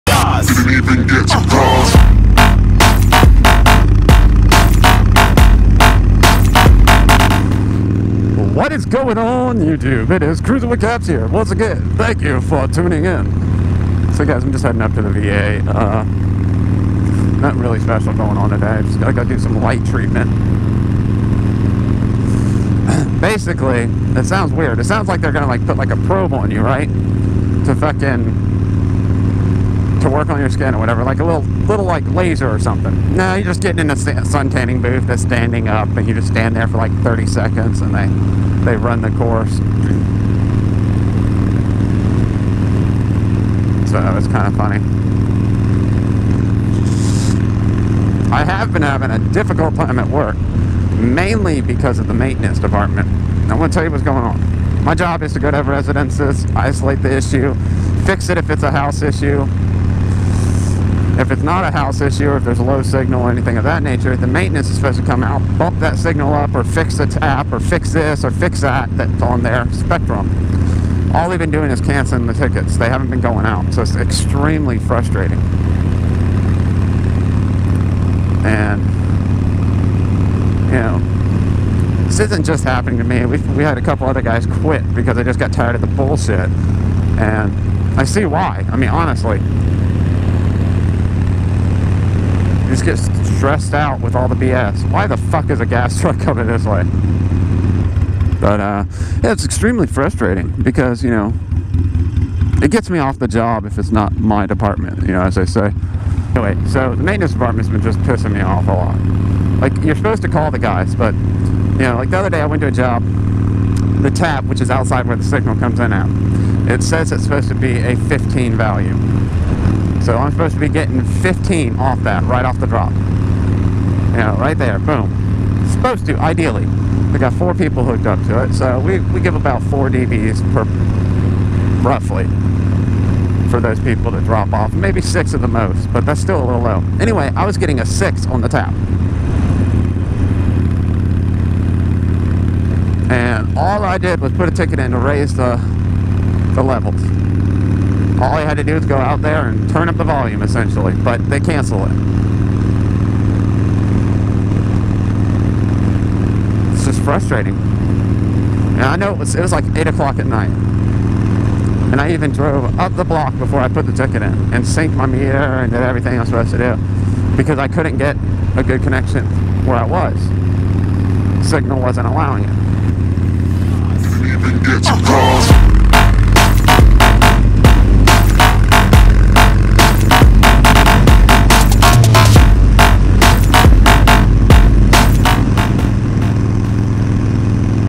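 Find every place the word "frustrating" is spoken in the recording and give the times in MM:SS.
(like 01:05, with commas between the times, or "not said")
01:14, 01:39, 02:37.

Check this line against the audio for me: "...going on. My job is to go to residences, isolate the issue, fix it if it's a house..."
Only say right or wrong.
right.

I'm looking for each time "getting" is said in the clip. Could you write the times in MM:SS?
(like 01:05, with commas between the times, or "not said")
00:33, 02:00, 02:17.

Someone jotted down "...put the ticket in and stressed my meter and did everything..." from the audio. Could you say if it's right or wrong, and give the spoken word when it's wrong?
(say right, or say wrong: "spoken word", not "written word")
wrong: "synced", not "stressed".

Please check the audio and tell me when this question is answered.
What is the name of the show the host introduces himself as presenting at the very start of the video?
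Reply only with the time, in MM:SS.
00:10.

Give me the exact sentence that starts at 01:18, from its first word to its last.
And, you know, this isn't just happening to me.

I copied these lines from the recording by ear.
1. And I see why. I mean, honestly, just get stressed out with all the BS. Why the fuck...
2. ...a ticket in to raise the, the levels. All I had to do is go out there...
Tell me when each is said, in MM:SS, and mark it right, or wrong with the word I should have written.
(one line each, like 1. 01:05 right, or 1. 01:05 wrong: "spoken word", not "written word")
1. 01:27 right
2. 02:24 right.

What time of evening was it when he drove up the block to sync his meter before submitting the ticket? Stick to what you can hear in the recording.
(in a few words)
8 o'clock.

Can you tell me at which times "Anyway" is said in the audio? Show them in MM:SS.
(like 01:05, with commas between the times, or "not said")
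01:46, 02:16.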